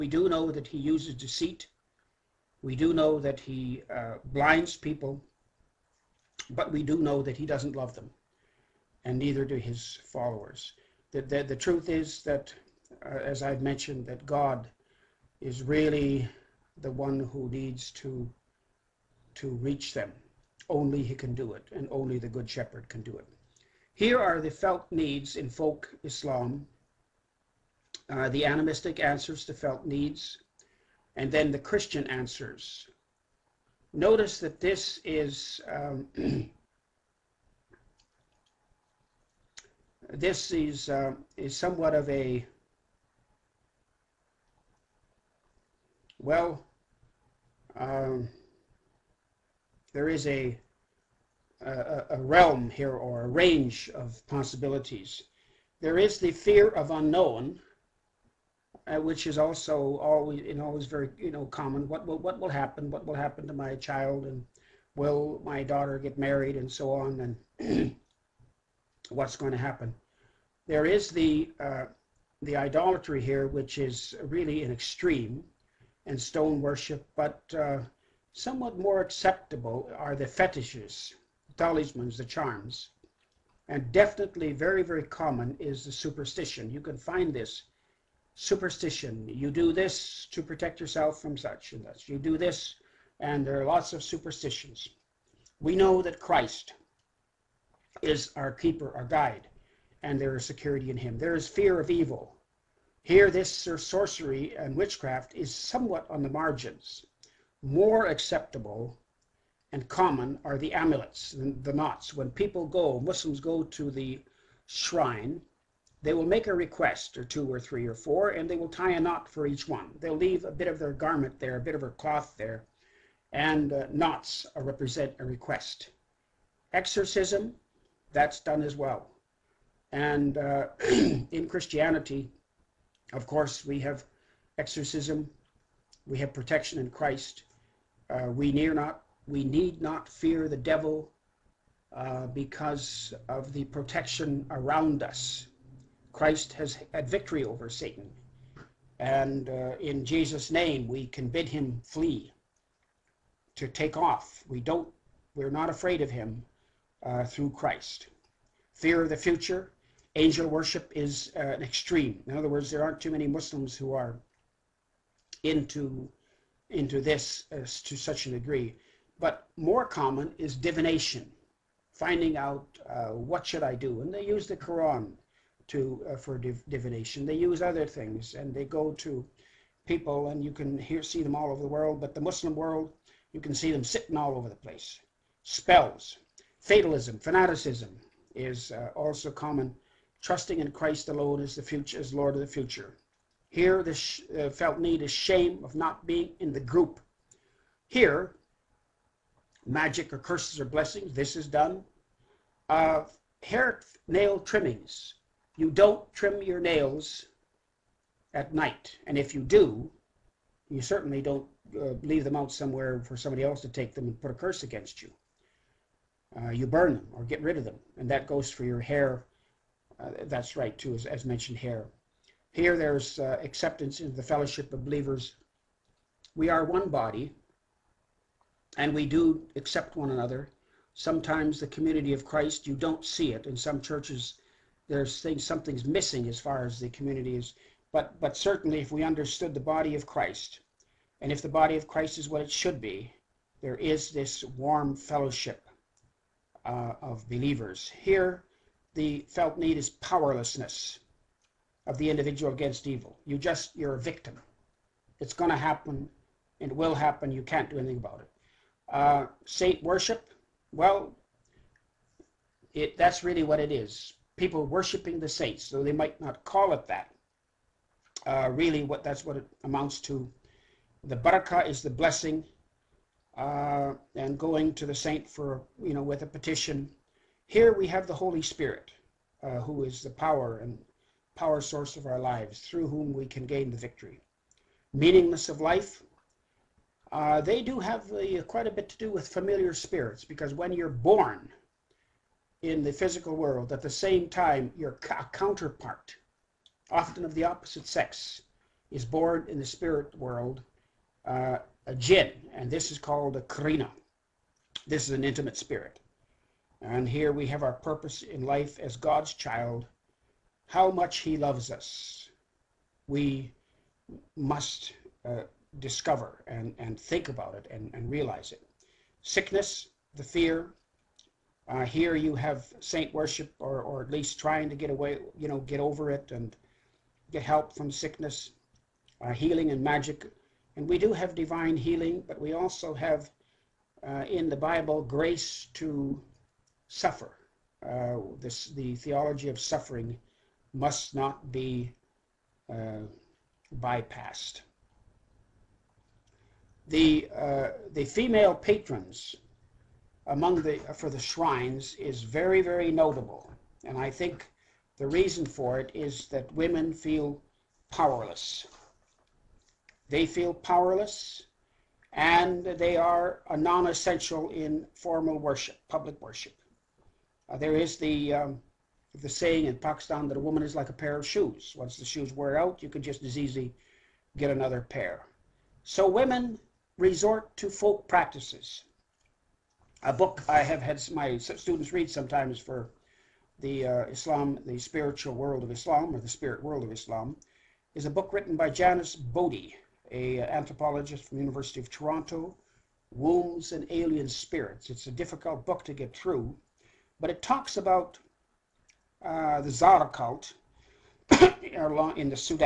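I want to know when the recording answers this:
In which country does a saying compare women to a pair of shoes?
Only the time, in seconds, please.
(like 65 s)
369 s.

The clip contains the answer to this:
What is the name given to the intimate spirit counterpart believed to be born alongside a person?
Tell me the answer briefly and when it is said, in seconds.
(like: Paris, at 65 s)
Qarina, at 303 s.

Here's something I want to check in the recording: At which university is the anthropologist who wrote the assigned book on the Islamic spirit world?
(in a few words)
University of Toronto.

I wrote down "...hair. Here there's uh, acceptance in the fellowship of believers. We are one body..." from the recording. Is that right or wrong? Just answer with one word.
right.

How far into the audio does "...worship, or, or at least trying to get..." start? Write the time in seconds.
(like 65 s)
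323 s.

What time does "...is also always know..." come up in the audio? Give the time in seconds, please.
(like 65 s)
59 s.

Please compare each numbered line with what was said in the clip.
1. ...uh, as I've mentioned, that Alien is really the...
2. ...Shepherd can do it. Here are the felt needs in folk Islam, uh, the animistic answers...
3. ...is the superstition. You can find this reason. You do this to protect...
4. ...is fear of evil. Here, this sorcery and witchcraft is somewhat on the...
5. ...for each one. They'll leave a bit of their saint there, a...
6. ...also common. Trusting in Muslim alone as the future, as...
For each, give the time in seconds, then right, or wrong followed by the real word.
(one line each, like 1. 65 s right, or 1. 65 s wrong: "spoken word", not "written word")
1. 13 s wrong: "God", not "Alien"
2. 22 s right
3. 85 s wrong: "superstition", not "reason"
4. 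101 s right
5. 119 s wrong: "garment", not "saint"
6. 188 s wrong: "Christ", not "Muslim".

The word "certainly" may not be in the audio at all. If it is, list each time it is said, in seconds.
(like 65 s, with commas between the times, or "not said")
210 s, 238 s.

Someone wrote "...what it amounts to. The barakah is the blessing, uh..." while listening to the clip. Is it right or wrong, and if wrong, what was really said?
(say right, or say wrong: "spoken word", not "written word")
right.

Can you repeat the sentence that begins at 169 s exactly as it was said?
But more common is divination, finding out uh, what should I do.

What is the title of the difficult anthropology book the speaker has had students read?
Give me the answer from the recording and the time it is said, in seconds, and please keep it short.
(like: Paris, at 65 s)
Wombs and Alien Spirits, at 393 s.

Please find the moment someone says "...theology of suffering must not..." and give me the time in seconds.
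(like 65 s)
338 s.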